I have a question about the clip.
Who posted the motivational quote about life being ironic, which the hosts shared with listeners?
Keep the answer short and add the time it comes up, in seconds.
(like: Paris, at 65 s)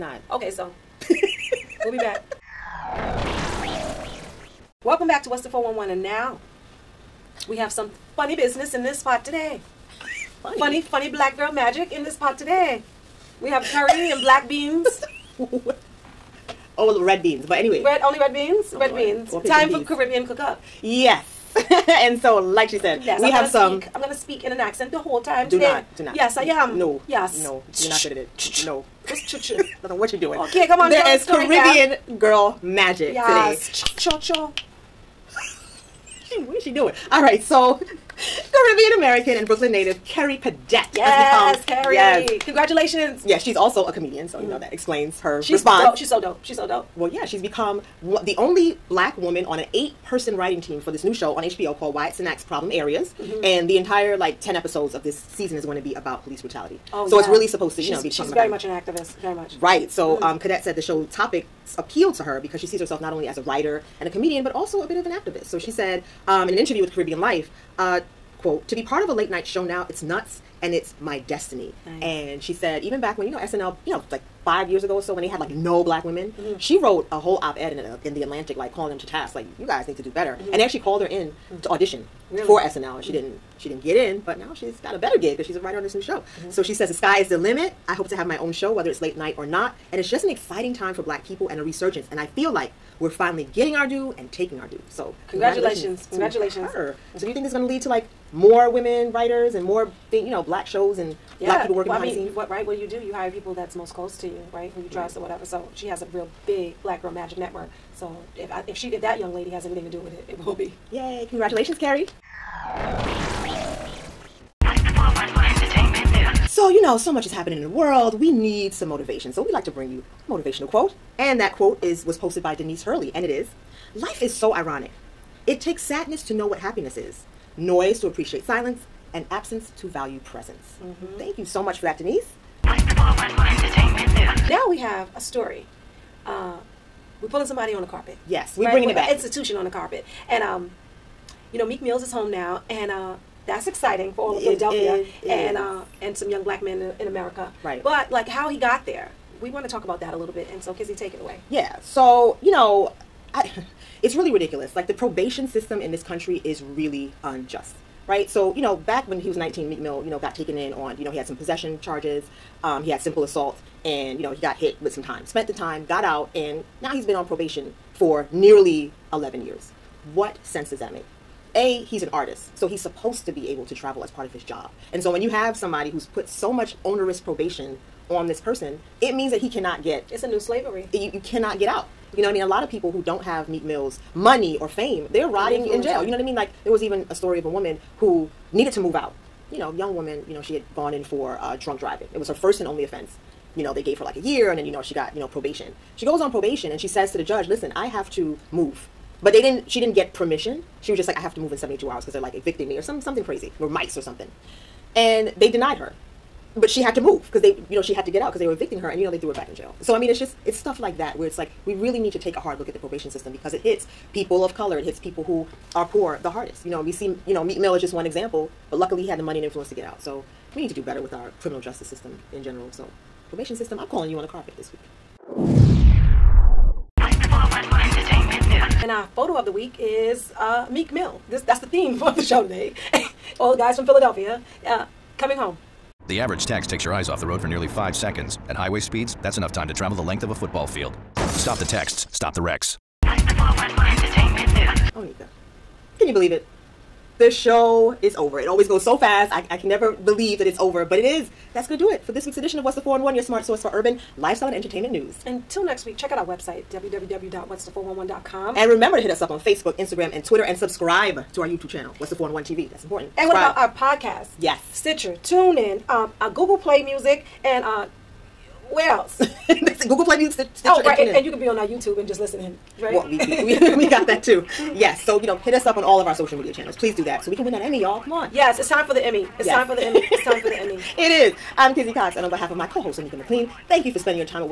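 Denise Hurley, at 122 s.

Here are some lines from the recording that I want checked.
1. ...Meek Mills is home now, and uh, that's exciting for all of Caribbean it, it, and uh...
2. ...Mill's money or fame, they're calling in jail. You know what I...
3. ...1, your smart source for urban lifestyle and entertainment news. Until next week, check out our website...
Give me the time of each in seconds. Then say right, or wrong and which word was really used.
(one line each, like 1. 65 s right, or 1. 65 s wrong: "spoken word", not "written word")
1. 141 s wrong: "Philadelphia", not "Caribbean"
2. 183 s wrong: "rotting", not "calling"
3. 253 s right.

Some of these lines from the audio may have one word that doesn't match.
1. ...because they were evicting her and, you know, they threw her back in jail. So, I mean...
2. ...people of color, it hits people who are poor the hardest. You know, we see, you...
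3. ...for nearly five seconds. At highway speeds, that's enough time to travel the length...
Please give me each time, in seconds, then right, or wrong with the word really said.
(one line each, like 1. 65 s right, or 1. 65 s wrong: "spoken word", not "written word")
1. 208 s right
2. 214 s right
3. 237 s right.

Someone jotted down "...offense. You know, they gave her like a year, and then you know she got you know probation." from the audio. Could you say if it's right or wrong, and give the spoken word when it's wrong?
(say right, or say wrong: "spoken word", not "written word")
right.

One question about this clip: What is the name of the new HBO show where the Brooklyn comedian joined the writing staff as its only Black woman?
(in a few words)
Wyatt Cenac's Problem Areas.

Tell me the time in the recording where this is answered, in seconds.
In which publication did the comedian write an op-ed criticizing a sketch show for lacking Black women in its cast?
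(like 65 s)
78 s.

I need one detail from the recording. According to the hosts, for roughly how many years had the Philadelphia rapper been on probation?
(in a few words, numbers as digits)
Nearly 11 years.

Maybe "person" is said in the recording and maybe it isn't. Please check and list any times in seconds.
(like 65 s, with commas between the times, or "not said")
50 s, 178 s.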